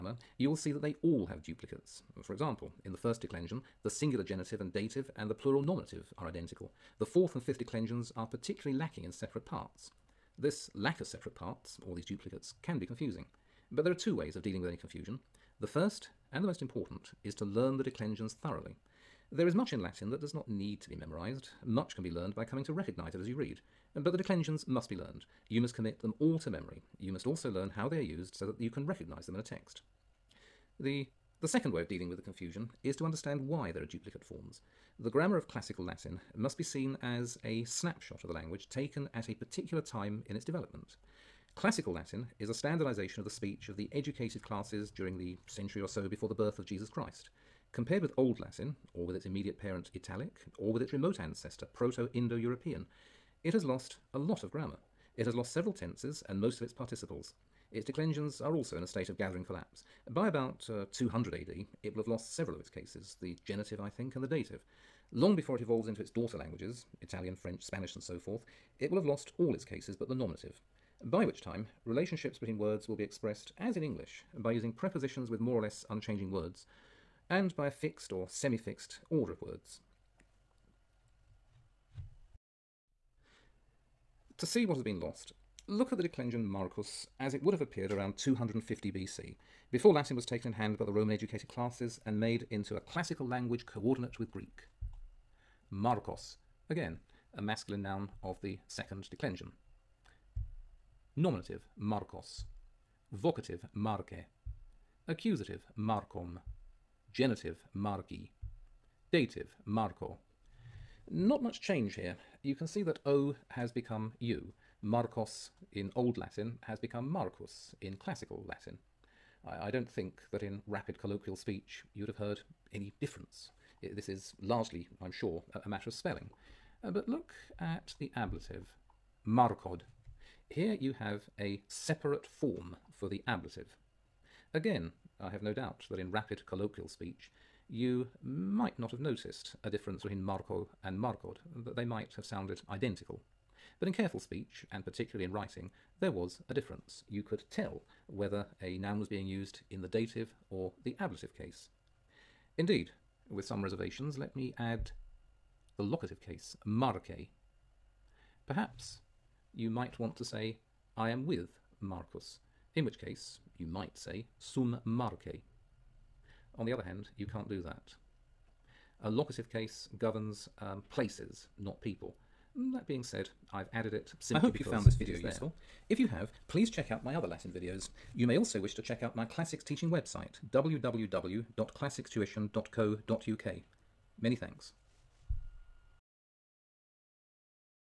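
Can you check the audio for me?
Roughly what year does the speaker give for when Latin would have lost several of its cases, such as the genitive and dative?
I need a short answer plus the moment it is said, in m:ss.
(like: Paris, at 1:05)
200 AD, at 1:00.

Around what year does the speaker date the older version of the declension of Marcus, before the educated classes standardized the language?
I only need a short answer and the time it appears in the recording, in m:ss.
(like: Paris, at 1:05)
250 BC, at 1:28.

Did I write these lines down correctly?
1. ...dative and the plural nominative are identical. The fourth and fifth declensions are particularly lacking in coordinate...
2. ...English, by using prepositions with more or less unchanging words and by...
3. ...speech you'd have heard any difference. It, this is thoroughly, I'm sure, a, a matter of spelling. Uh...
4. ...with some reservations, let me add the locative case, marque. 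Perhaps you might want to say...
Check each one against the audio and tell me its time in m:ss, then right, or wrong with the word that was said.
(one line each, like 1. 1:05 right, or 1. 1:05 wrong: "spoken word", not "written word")
1. 0:04 wrong: "separate", not "coordinate"
2. 1:13 right
3. 2:01 wrong: "largely", not "thoroughly"
4. 2:33 right.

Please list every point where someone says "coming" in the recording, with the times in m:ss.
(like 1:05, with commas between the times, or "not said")
0:22.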